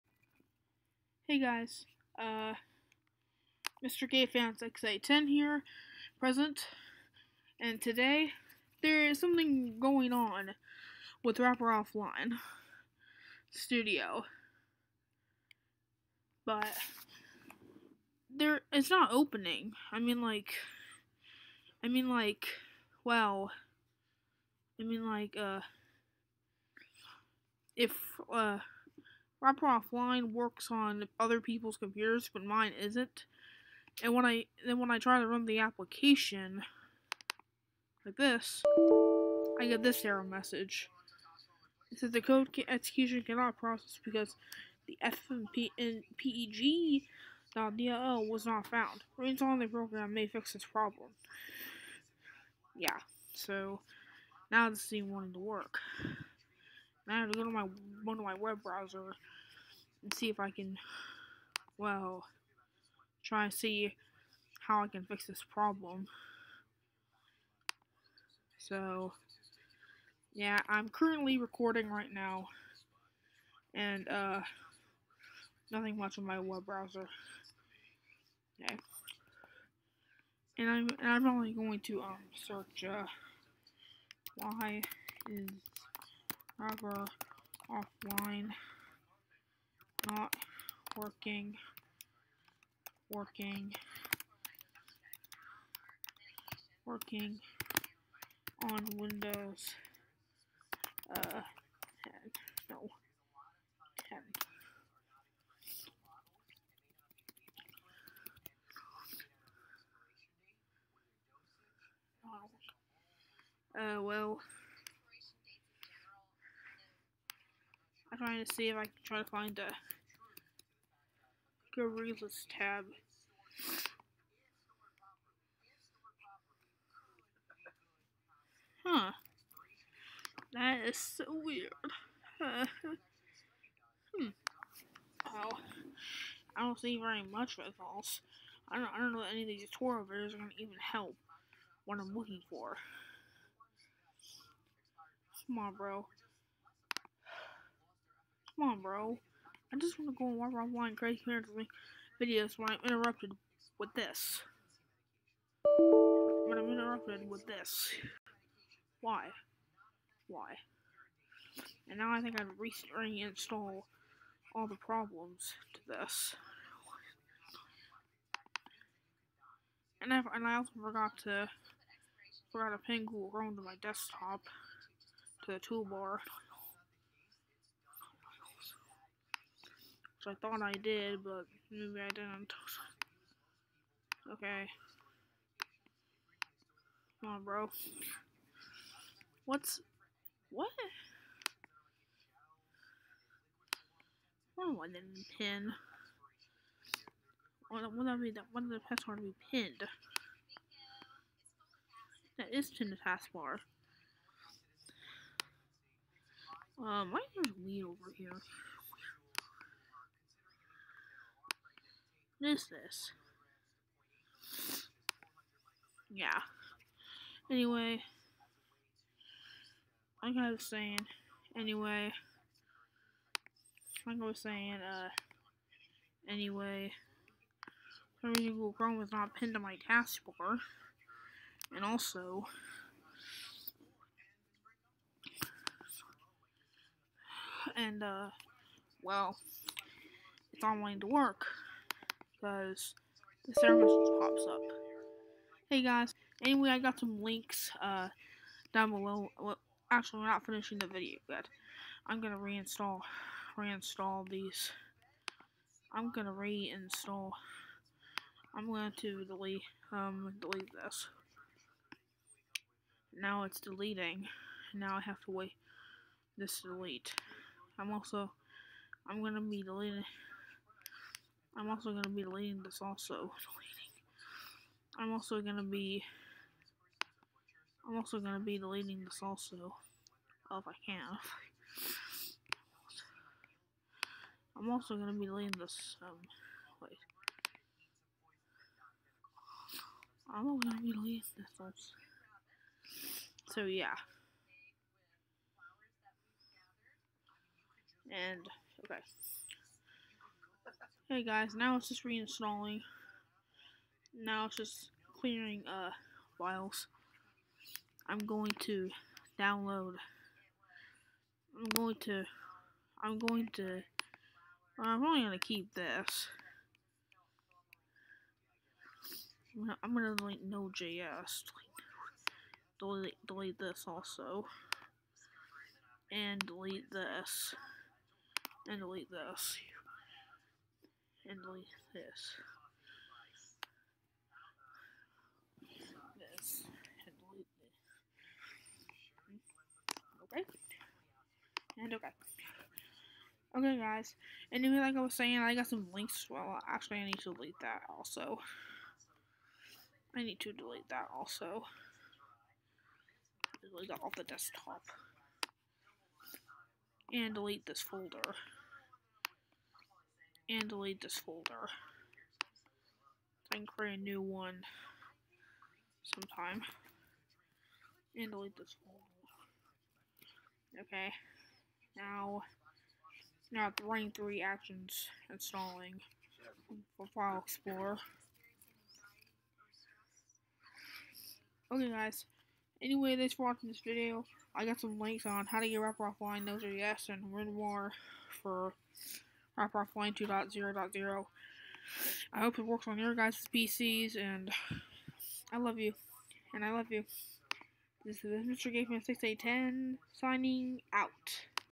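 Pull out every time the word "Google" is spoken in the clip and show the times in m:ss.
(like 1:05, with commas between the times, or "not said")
2:53, 3:48.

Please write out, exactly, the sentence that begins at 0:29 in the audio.
Wrapper Offline works on other people's computers, but mine isn't.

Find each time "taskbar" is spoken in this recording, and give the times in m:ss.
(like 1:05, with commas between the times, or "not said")
3:22, 3:49.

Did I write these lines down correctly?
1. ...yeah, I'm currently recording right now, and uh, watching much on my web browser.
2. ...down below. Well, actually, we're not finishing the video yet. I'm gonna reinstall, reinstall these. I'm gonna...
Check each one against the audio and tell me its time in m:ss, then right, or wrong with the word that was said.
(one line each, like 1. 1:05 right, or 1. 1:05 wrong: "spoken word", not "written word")
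1. 1:10 wrong: "nothing", not "watching"
2. 4:08 right.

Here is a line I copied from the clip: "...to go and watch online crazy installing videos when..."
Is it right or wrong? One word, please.
wrong.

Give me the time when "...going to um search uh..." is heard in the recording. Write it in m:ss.
1:21.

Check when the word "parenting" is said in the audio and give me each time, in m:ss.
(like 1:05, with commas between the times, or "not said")
2:31.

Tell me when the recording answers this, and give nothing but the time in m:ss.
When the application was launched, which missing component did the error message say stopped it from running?
0:45.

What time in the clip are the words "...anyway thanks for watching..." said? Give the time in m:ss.
6:22.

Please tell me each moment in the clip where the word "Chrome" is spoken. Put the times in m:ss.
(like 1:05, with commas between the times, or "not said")
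2:53, 3:48.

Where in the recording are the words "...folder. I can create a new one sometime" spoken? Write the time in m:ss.
6:01.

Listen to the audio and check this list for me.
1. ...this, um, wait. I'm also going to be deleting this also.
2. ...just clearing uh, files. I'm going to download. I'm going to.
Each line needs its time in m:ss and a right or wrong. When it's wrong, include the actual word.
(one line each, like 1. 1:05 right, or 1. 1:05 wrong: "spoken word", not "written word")
1. 4:45 right
2. 5:04 right.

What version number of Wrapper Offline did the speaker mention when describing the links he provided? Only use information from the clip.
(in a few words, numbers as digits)
2.0.0.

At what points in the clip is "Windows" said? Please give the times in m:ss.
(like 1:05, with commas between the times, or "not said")
1:38.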